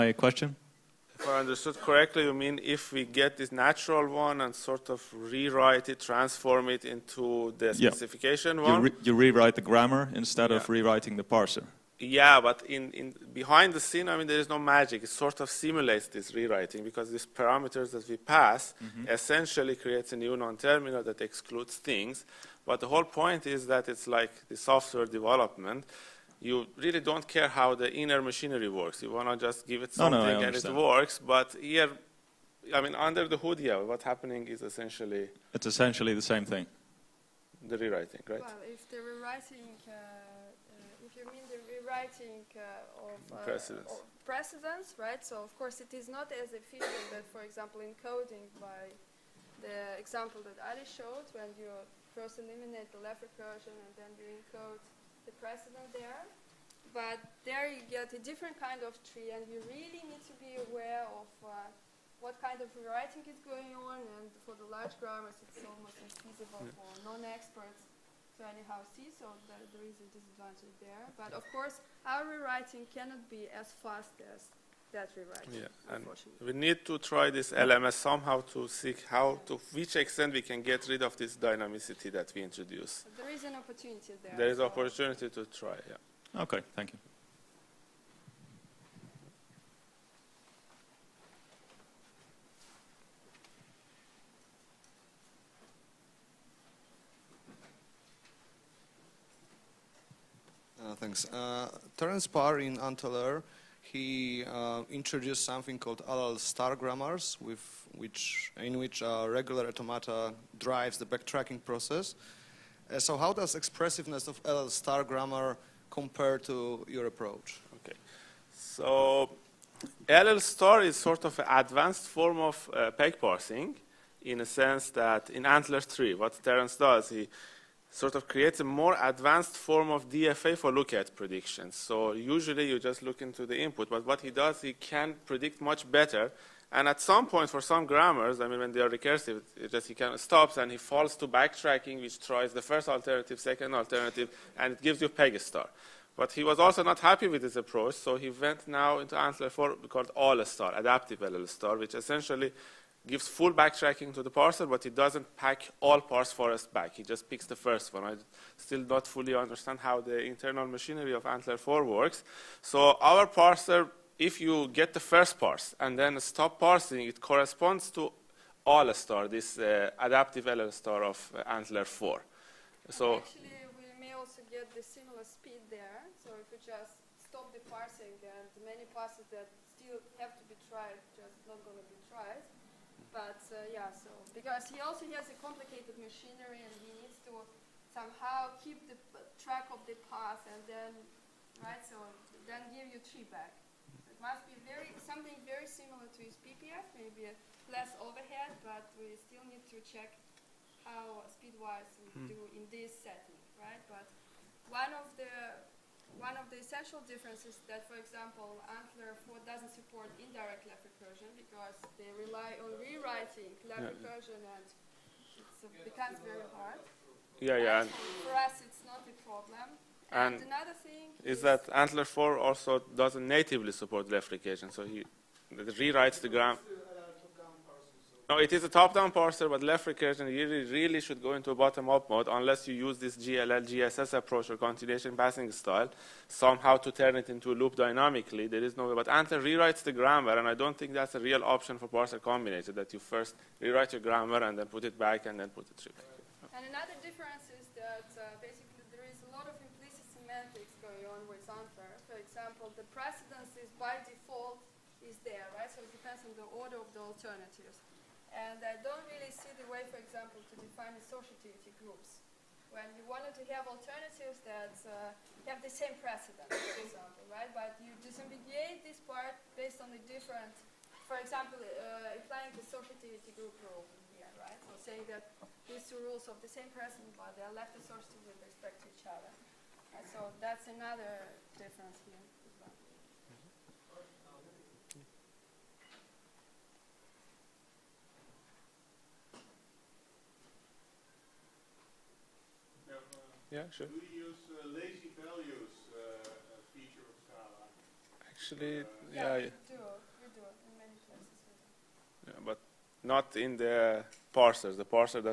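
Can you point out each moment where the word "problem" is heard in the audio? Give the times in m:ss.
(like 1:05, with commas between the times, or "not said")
3:39.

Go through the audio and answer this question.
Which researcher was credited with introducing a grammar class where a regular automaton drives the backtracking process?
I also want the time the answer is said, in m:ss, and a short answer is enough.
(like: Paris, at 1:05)
Terence Parr, at 1:41.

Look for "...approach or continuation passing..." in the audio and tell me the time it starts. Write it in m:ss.
3:54.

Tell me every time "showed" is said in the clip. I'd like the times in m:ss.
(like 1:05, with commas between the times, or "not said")
0:50.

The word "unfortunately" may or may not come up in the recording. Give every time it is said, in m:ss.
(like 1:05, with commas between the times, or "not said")
1:15.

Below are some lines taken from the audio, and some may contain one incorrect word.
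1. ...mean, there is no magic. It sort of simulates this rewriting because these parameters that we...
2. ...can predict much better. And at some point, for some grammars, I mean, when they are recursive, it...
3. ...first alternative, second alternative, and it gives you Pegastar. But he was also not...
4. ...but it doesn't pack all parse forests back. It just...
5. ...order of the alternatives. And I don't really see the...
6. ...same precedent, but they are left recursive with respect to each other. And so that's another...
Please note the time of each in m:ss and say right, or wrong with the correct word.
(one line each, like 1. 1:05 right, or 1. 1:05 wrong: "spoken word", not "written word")
1. 0:14 right
2. 2:14 right
3. 2:22 right
4. 2:34 right
5. 4:16 right
6. 4:36 wrong: "associative", not "recursive".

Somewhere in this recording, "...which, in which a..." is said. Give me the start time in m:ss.
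1:47.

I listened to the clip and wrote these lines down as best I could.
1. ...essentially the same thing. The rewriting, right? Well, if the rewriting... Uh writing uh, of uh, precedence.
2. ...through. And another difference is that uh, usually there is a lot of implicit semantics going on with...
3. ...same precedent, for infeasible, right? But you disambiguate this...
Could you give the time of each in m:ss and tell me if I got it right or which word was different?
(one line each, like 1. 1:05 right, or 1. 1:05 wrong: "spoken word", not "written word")
1. 0:35 right
2. 4:05 wrong: "basically", not "usually"
3. 4:25 wrong: "example", not "infeasible".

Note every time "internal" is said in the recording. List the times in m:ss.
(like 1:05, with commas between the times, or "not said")
2:40.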